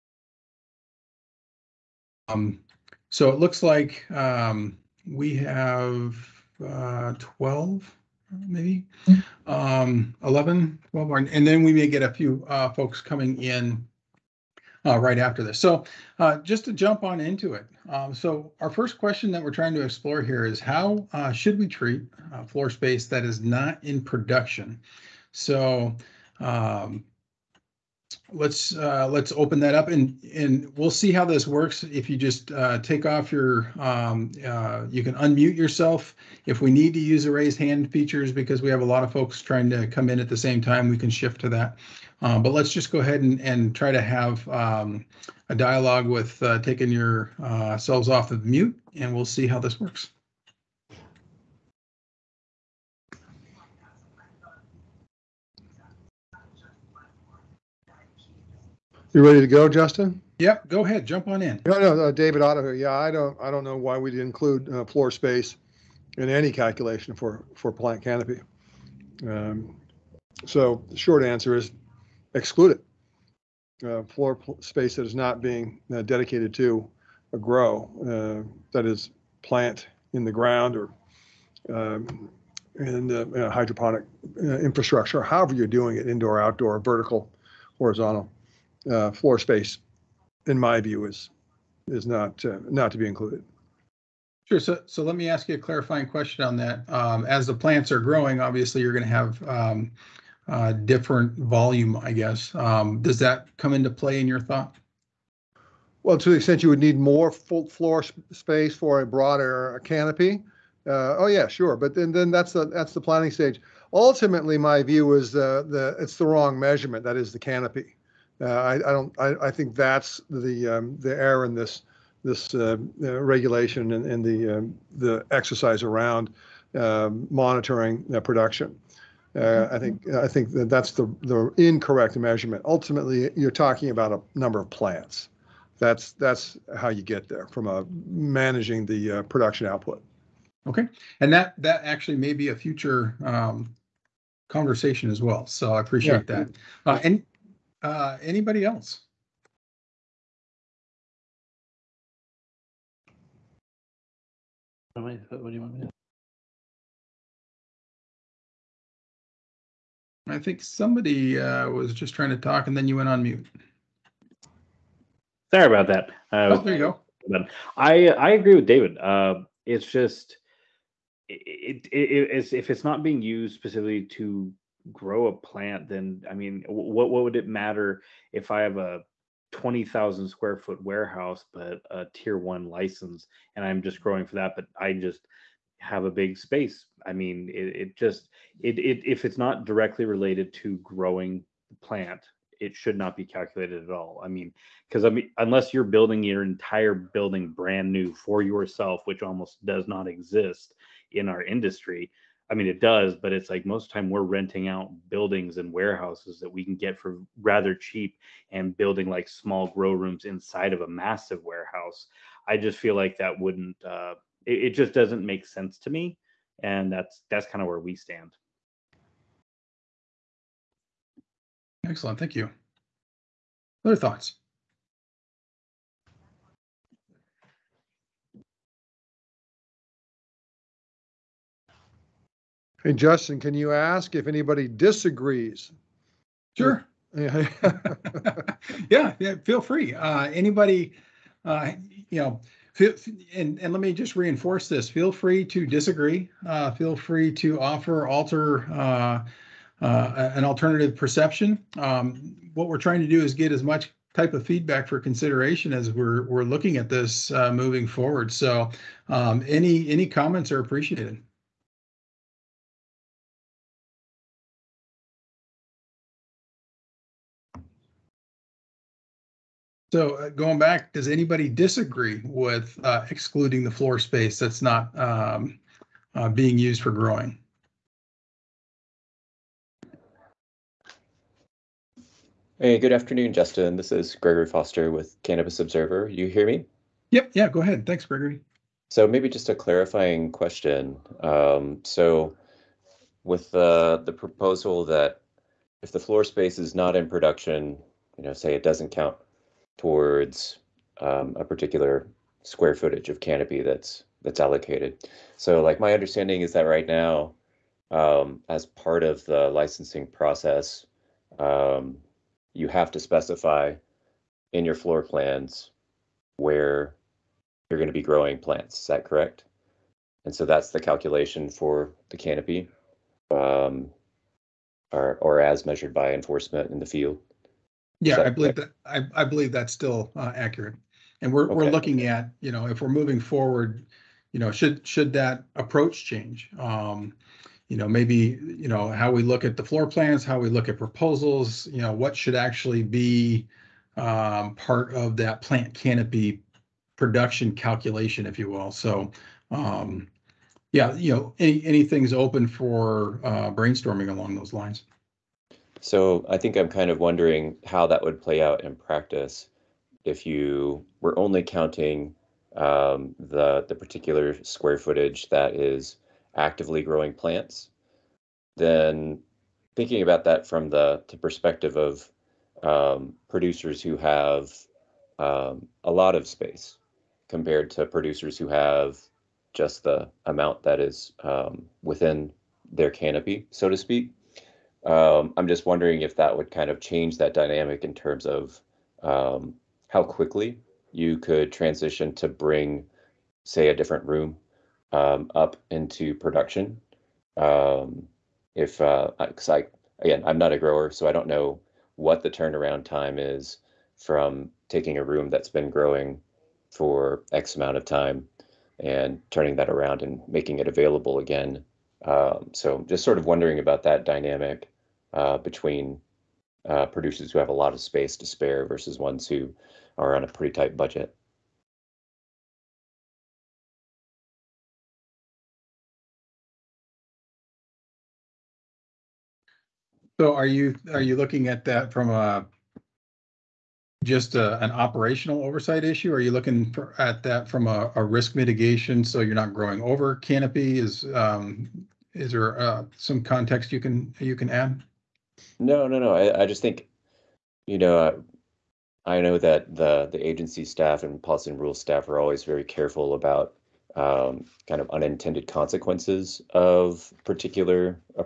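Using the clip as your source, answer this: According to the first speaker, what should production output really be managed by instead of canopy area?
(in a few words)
a number of plants.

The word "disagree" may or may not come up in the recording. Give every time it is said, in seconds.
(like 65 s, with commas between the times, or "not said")
234 s, 245 s, 271 s.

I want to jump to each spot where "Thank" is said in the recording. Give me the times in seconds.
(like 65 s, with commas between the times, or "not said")
222 s, 287 s.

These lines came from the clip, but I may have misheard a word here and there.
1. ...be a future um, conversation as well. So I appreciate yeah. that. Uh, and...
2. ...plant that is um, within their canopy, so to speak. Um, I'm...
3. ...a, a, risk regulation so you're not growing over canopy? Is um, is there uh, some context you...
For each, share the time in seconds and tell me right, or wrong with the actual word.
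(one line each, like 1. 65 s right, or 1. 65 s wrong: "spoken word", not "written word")
1. 142 s right
2. 380 s wrong: "amount", not "plant"
3. 437 s wrong: "mitigation", not "regulation".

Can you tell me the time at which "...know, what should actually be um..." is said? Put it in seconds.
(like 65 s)
341 s.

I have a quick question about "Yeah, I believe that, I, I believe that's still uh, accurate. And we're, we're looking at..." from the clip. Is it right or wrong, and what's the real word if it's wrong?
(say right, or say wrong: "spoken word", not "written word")
right.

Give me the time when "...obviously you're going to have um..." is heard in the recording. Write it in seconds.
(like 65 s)
98 s.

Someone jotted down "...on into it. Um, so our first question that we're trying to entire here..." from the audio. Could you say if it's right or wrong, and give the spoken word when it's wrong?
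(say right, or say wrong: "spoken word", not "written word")
wrong: "explore", not "entire".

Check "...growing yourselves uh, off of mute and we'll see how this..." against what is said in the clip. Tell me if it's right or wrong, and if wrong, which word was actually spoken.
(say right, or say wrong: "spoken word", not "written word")
wrong: "taking", not "growing".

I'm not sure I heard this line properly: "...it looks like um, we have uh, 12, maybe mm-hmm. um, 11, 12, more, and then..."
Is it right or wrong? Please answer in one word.
right.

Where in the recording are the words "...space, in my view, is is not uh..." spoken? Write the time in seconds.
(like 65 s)
89 s.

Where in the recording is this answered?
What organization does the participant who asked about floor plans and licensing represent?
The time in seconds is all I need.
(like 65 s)
285 s.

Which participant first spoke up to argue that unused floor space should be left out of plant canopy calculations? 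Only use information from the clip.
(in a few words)
David Otto.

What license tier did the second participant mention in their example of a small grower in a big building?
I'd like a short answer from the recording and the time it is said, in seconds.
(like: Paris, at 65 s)
tier one, at 182 s.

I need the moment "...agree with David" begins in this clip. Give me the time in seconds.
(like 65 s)
168 s.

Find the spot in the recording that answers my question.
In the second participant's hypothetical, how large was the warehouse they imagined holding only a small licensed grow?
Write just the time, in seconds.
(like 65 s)
179 s.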